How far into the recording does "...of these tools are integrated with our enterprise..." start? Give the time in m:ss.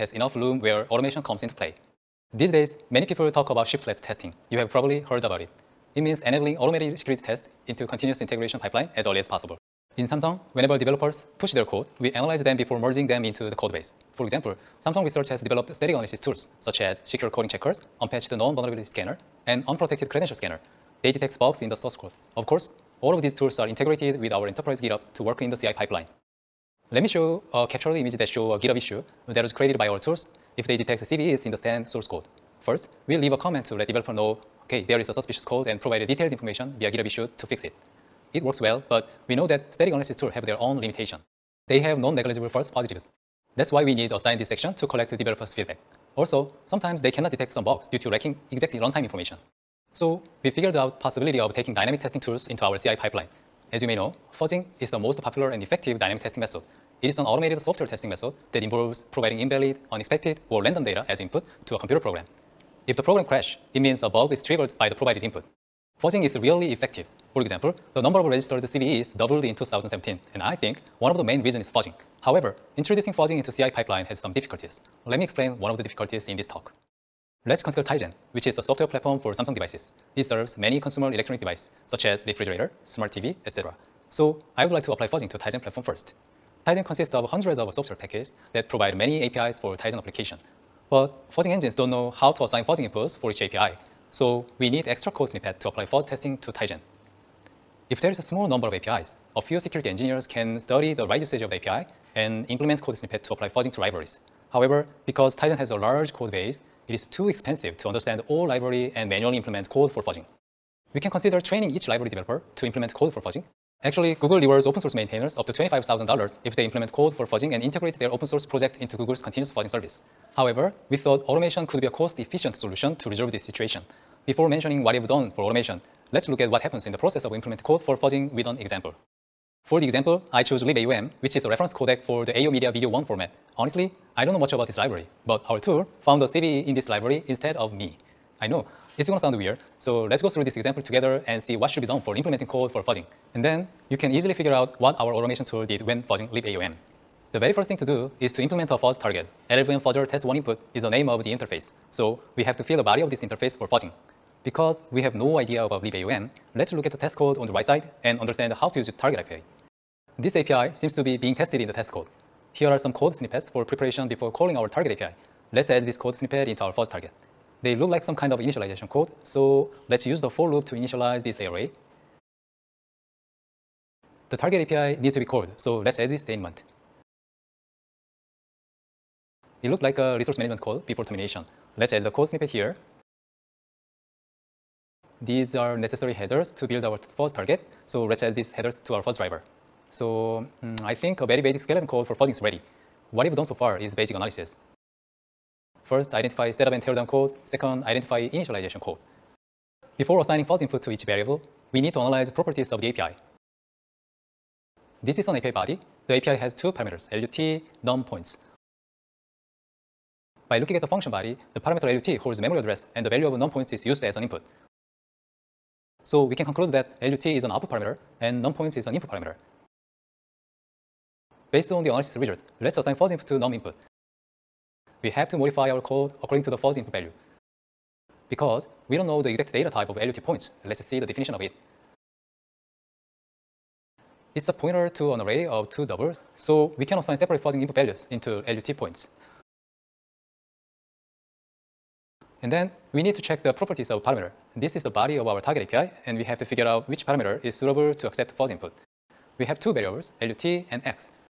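0:23.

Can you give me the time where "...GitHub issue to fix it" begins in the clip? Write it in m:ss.
0:36.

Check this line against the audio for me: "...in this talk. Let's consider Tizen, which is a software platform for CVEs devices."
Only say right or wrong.
wrong.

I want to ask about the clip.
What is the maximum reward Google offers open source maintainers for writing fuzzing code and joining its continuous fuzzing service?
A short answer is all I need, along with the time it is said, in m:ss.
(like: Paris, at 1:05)
$25,000, at 1:55.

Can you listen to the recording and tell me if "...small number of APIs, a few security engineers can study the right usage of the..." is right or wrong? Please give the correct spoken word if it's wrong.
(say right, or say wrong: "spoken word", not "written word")
right.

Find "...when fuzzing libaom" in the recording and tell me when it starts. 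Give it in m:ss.
2:25.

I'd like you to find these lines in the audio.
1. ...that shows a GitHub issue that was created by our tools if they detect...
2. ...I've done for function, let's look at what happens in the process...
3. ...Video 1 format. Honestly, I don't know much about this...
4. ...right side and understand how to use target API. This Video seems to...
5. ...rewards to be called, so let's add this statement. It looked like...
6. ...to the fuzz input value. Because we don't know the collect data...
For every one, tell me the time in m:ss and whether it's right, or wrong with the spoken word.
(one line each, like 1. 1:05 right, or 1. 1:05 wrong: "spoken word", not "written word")
1. 0:28 right
2. 2:04 wrong: "automation", not "function"
3. 2:12 right
4. 2:37 wrong: "API", not "Video"
5. 2:54 wrong: "needs", not "rewards"
6. 3:46 wrong: "exact", not "collect".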